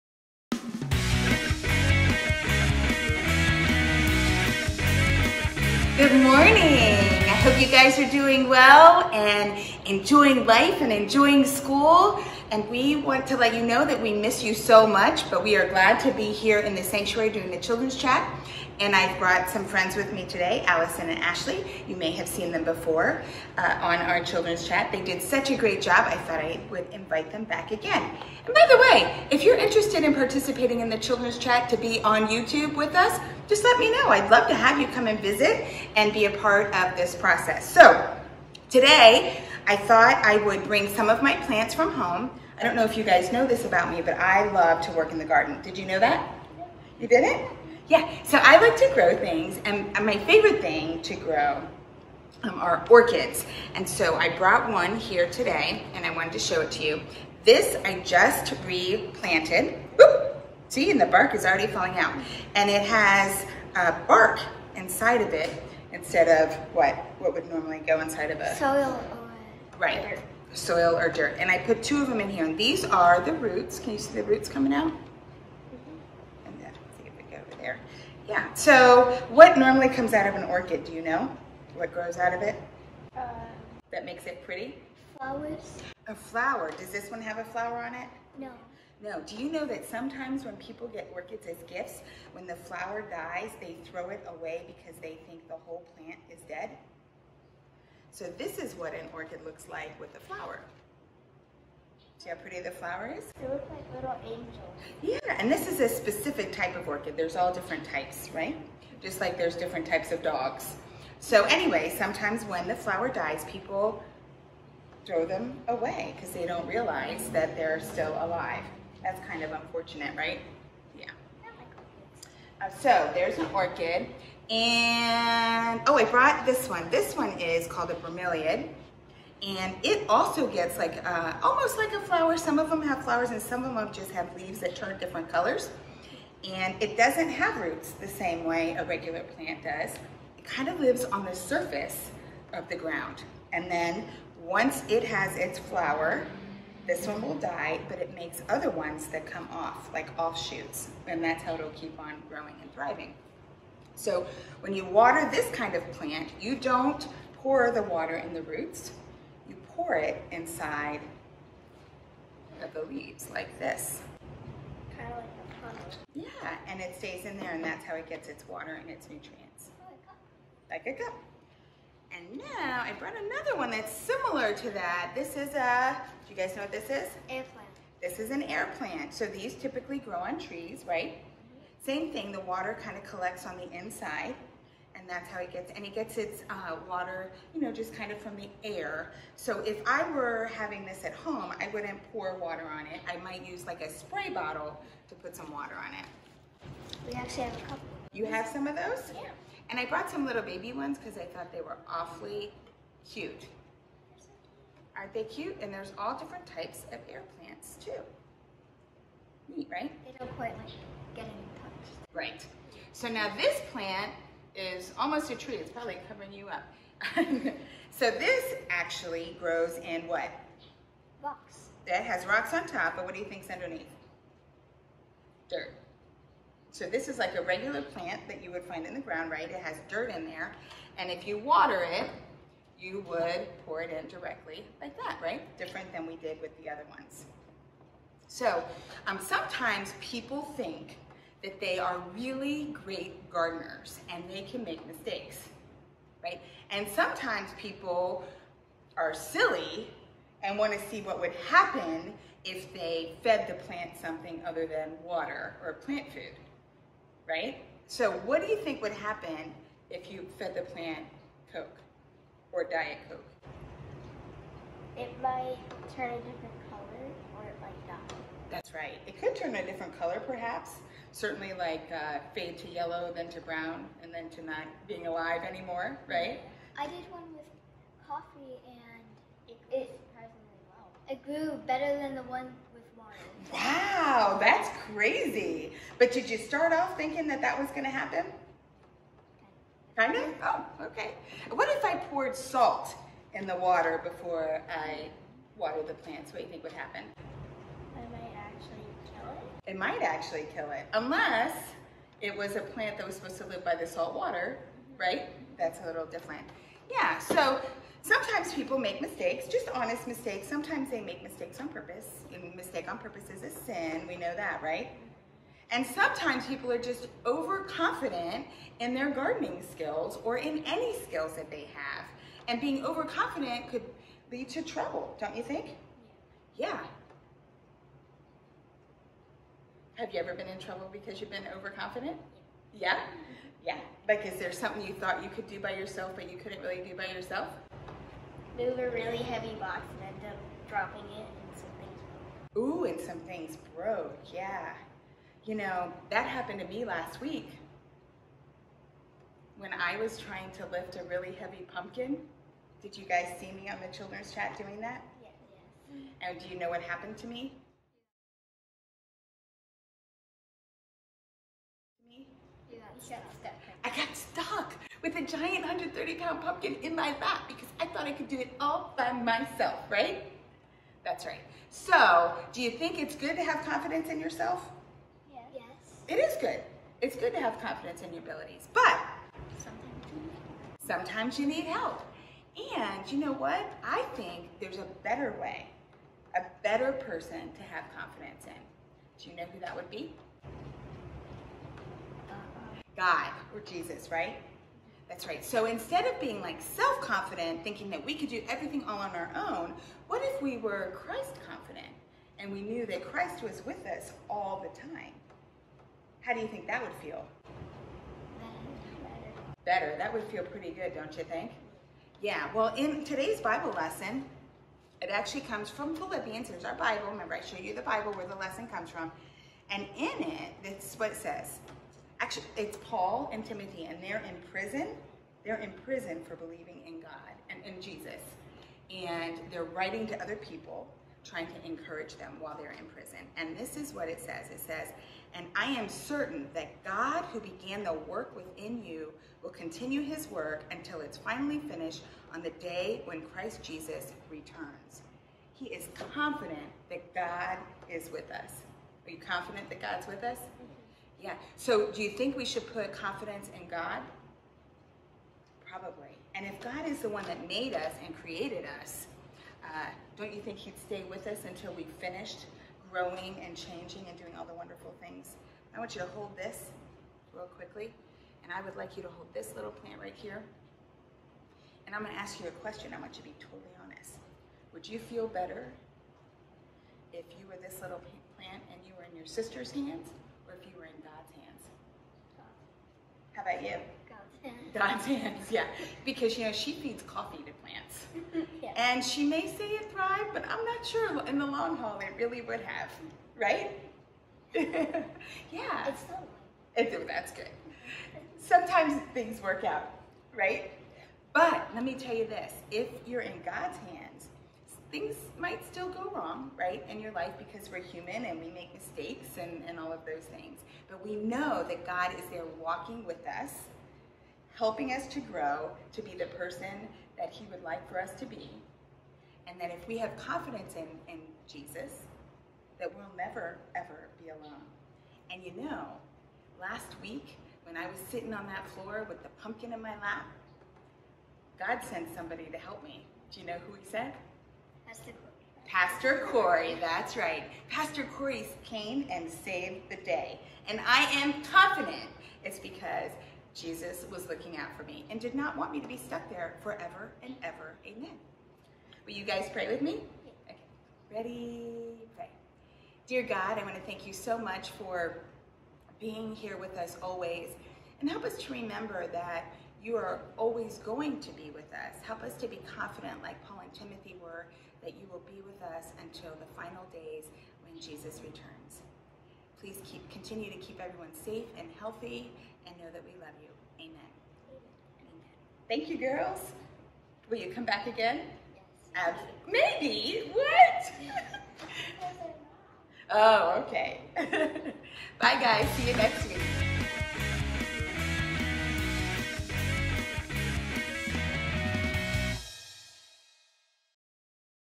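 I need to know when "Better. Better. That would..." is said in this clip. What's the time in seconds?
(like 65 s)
408 s.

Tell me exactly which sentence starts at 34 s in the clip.
I'd love to have you come and visit and be a part of this process.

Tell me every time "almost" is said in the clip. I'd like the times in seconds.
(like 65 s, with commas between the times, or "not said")
131 s, 214 s.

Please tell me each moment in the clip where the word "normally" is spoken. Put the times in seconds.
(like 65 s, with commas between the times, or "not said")
67 s, 79 s.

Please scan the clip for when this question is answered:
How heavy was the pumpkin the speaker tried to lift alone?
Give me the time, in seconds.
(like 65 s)
365 s.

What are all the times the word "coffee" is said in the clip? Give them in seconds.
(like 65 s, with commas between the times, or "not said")
278 s, 487 s.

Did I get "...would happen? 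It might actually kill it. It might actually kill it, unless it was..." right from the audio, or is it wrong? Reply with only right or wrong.
right.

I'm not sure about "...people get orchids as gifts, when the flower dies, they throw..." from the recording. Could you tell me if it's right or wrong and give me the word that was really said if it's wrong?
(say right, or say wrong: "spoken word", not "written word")
right.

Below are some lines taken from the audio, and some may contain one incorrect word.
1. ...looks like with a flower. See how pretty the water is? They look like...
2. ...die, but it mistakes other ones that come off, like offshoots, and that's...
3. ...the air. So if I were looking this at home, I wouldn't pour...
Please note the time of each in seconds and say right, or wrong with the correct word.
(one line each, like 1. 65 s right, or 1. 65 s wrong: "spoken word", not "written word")
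1. 99 s wrong: "flower", not "water"
2. 147 s wrong: "makes", not "mistakes"
3. 188 s wrong: "having", not "looking".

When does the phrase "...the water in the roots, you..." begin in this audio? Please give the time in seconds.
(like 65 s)
157 s.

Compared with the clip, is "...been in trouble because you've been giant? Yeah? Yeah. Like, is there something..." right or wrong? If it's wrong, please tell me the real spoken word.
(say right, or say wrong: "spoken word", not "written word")
wrong: "overconfident", not "giant".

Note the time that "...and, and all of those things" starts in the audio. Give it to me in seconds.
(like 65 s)
509 s.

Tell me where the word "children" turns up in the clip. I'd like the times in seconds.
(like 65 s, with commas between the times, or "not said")
17 s, 24 s, 30 s, 353 s.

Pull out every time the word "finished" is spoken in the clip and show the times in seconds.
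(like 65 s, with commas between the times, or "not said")
441 s, 461 s.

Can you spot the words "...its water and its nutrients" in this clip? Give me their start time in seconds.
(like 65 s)
168 s.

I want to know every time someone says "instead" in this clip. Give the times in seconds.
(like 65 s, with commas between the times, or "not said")
66 s, 395 s.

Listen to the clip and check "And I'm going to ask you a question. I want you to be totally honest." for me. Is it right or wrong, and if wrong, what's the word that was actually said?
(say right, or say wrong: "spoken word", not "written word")
right.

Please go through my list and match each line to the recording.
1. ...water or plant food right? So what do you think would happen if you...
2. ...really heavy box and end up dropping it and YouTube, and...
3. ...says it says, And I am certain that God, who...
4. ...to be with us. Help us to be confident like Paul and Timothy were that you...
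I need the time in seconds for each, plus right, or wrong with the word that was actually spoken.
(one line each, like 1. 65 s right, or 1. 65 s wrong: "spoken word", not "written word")
1. 255 s right
2. 338 s wrong: "Ooh", not "YouTube"
3. 434 s right
4. 561 s right.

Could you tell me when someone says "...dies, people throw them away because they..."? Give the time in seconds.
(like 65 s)
113 s.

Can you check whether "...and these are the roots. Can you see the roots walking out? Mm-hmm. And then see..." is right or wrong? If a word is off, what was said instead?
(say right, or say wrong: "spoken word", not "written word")
wrong: "coming", not "walking".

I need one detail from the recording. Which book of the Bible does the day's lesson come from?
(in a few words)
Philippians.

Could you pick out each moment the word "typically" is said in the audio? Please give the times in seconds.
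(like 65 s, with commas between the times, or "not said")
179 s.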